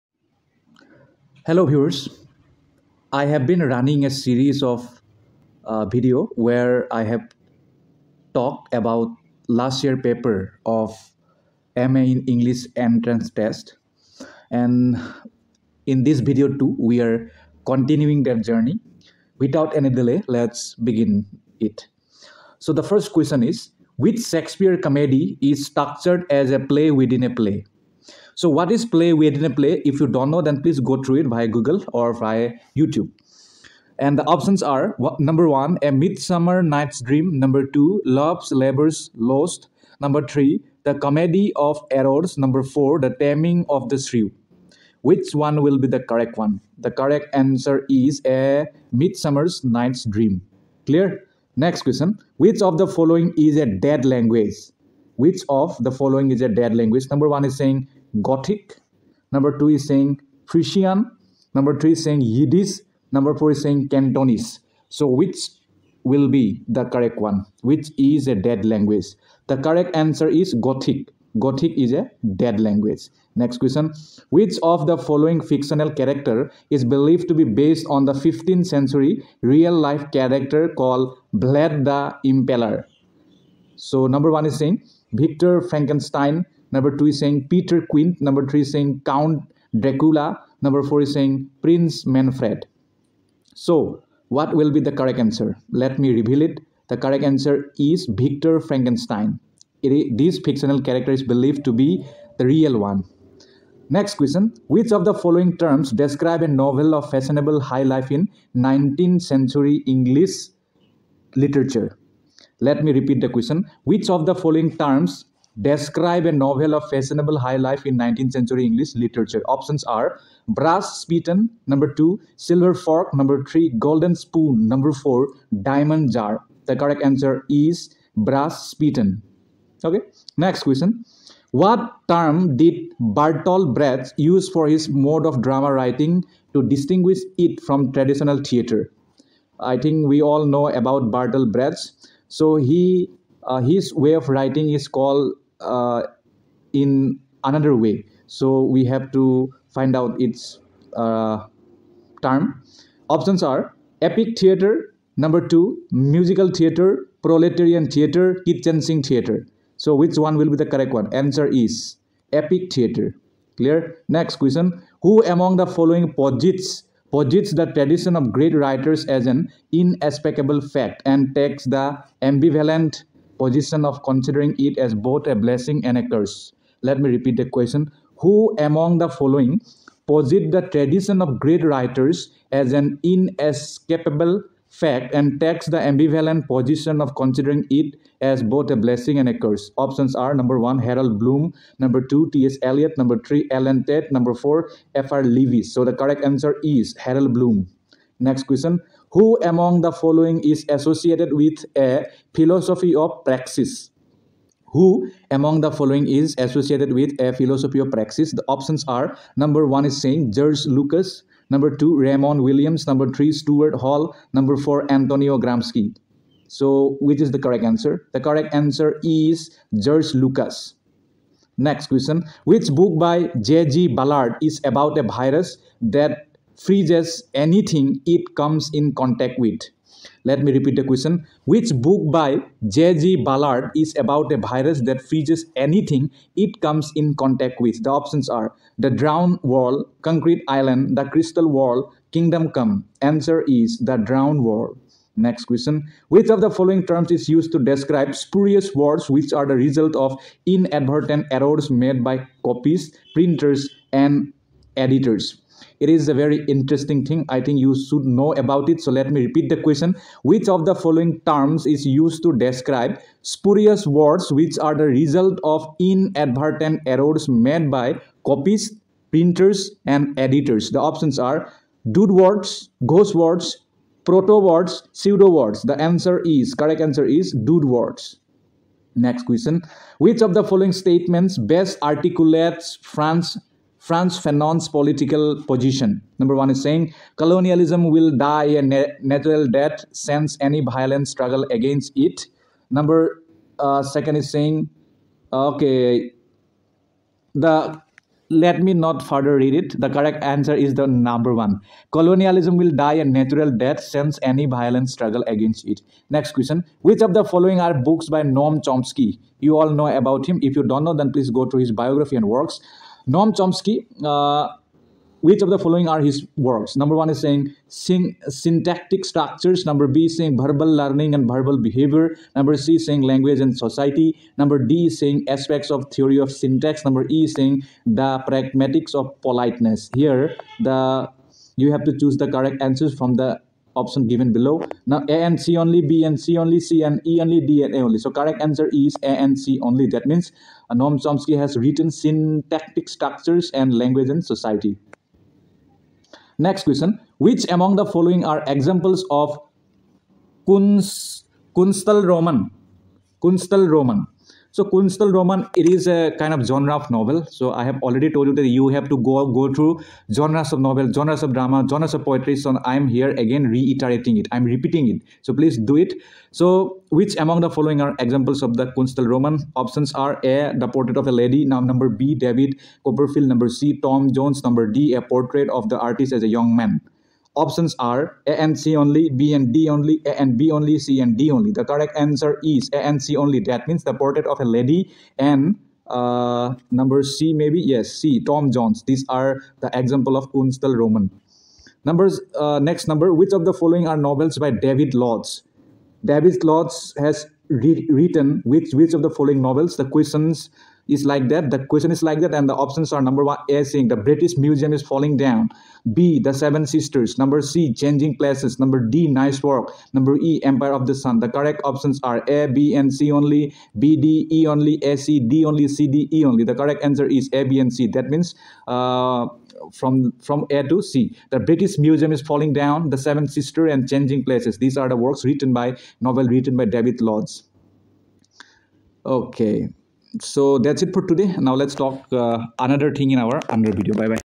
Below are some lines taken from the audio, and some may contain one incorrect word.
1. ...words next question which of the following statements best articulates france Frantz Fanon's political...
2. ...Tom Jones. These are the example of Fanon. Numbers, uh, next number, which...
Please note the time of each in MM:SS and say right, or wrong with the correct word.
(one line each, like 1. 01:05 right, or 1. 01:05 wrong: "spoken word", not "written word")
1. 04:37 right
2. 06:28 wrong: "Künstlerroman", not "Fanon".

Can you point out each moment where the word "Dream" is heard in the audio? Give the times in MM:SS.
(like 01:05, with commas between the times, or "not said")
00:37, 00:50.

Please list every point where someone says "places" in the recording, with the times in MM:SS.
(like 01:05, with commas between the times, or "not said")
06:48, 07:04.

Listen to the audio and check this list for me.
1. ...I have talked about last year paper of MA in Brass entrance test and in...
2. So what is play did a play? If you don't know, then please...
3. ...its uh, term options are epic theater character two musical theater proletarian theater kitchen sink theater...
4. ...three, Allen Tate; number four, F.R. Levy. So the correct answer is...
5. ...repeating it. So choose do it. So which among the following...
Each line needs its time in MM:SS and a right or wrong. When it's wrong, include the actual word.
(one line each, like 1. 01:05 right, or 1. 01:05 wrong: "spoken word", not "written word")
1. 00:06 wrong: "English", not "Brass"
2. 00:28 right
3. 02:30 wrong: "number", not "character"
4. 03:13 right
5. 06:04 wrong: "please", not "choose".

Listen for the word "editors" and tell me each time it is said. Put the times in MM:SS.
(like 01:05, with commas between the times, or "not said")
04:14, 04:30.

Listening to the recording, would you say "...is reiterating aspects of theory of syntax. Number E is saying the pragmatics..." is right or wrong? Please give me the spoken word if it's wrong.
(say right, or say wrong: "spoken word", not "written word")
wrong: "saying", not "reiterating".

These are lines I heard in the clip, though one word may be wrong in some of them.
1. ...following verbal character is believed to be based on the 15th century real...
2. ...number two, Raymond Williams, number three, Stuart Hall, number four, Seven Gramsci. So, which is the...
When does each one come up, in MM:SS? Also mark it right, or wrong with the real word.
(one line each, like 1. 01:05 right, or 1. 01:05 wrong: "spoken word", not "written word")
1. 01:14 wrong: "fictional", not "verbal"
2. 03:31 wrong: "Antonio", not "Seven".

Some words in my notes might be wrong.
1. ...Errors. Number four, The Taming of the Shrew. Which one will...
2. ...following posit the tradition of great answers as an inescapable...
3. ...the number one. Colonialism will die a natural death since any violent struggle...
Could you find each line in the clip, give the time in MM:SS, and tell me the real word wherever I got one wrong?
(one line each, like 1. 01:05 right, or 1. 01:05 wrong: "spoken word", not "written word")
1. 00:41 right
2. 02:59 wrong: "writers", not "answers"
3. 05:00 right.